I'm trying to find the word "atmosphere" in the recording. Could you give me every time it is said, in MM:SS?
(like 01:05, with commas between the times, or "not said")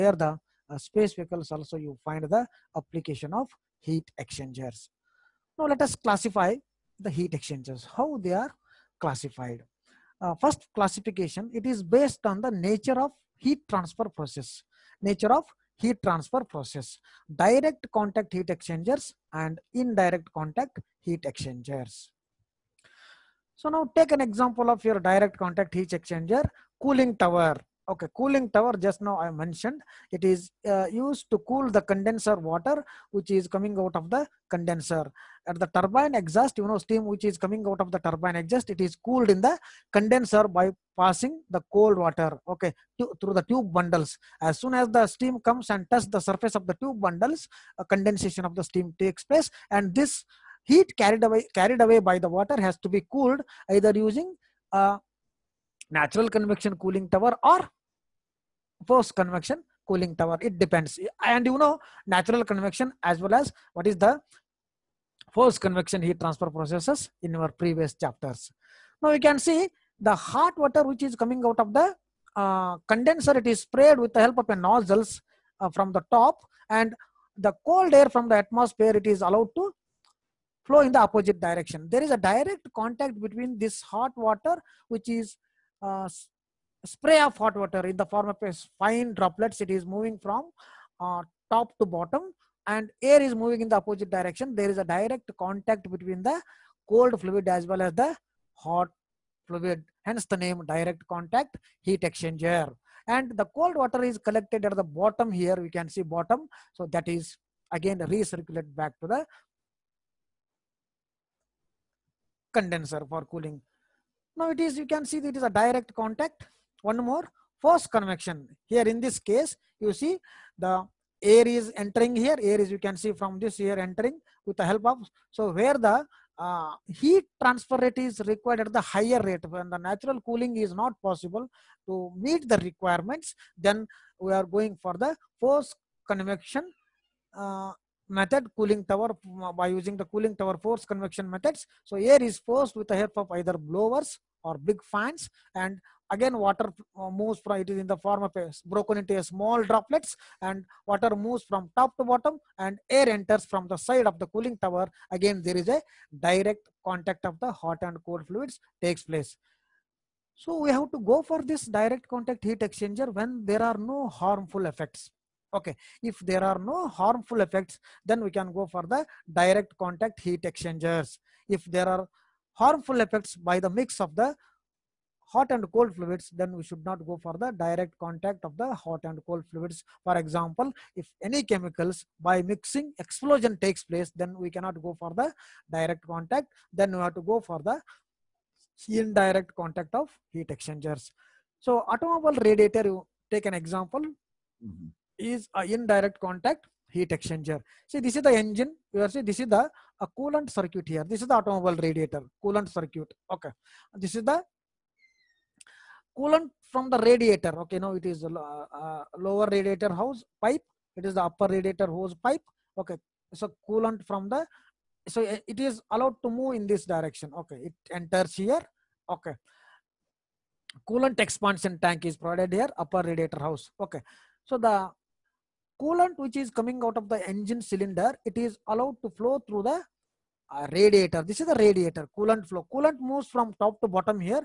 01:18.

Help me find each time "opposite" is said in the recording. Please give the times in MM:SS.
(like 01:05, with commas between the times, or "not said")
01:20, 01:33.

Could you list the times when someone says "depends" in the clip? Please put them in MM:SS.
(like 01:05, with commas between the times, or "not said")
01:00.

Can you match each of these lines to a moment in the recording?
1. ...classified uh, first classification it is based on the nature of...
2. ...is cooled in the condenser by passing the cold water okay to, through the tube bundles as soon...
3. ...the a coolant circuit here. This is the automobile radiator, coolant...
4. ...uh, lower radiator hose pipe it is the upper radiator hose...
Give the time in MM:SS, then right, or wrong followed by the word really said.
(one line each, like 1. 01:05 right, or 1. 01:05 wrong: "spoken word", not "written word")
1. 00:08 right
2. 00:38 right
3. 03:19 right
4. 03:28 right.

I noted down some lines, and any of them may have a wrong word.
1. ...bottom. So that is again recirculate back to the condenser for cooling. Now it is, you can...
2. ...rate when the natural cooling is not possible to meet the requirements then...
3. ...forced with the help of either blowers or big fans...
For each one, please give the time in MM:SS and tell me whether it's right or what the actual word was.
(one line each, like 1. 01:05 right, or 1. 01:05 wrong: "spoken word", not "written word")
1. 01:46 right
2. 02:09 right
3. 02:22 right.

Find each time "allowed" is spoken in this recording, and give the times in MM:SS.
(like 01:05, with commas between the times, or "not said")
01:19, 03:35, 03:48.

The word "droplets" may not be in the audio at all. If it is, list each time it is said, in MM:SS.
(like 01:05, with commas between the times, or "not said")
01:29, 02:29.